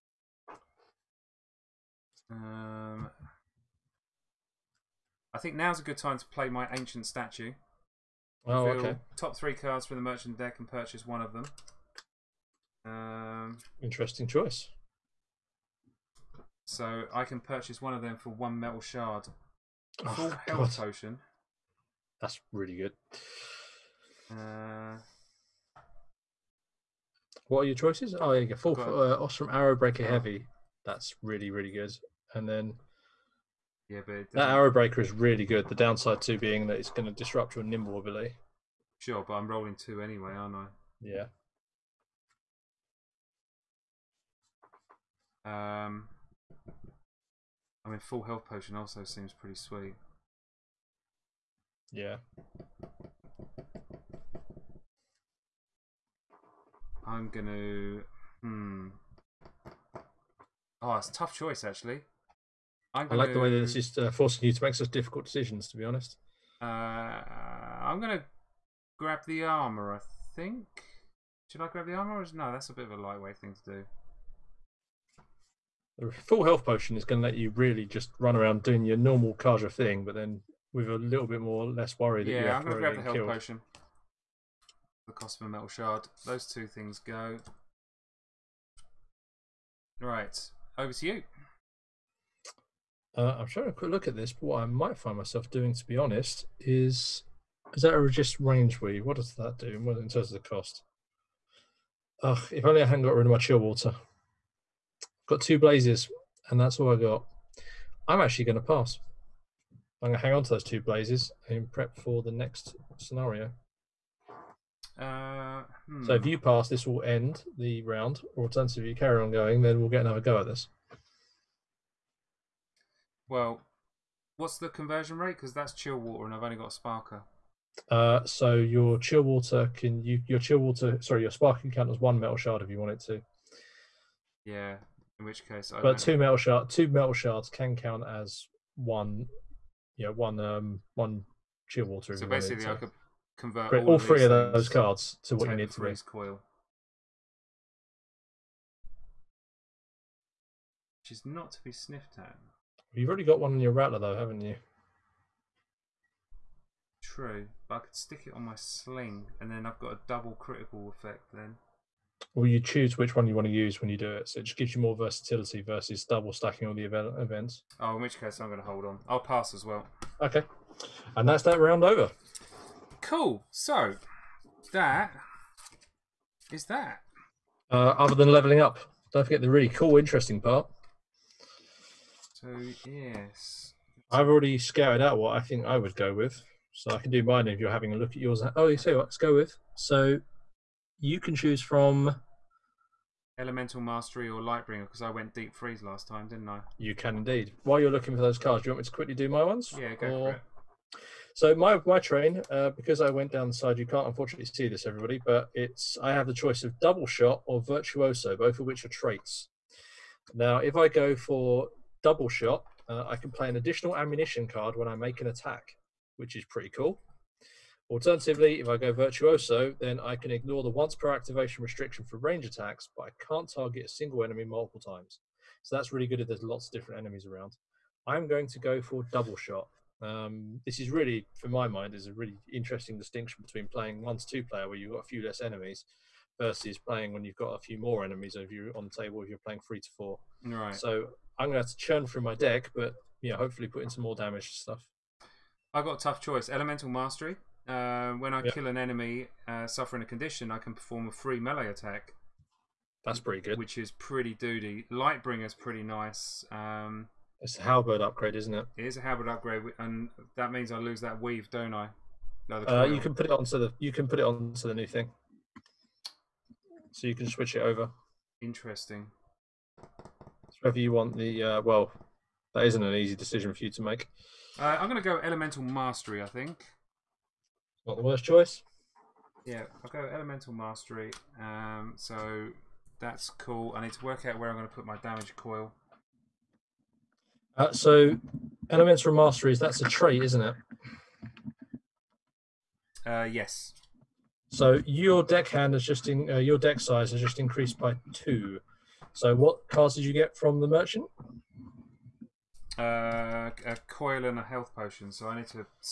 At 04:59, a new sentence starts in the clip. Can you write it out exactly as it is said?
So, what cards did you get from the merchant?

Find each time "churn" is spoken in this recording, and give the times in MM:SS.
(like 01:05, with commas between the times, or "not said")
04:01.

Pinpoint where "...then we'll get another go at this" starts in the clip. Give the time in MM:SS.
01:59.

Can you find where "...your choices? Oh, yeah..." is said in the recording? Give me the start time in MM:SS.
00:27.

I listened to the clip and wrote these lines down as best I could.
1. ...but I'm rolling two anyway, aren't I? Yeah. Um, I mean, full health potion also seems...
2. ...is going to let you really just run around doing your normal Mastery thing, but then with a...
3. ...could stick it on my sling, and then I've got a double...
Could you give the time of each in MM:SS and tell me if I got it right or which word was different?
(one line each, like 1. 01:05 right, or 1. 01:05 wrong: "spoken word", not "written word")
1. 00:39 right
2. 01:16 wrong: "Carja", not "Mastery"
3. 02:37 right.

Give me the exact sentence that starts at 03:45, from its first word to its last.
So that's really good if there's lots of different enemies around.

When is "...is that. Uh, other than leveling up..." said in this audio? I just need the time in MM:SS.
02:56.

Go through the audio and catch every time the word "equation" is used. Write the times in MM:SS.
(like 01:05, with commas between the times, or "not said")
not said.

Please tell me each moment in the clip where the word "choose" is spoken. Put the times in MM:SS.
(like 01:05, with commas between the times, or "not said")
02:42, 03:11.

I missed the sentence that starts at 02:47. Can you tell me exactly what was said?
Oh, in which case I'm going to hold on.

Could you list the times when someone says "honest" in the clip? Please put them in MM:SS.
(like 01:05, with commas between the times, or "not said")
01:05, 01:35.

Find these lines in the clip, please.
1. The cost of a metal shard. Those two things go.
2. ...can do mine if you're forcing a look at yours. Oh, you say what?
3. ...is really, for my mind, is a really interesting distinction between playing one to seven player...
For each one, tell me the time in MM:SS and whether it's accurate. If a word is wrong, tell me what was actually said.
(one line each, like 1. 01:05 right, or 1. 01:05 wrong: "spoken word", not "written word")
1. 01:25 right
2. 03:06 wrong: "having", not "forcing"
3. 03:50 wrong: "two", not "seven".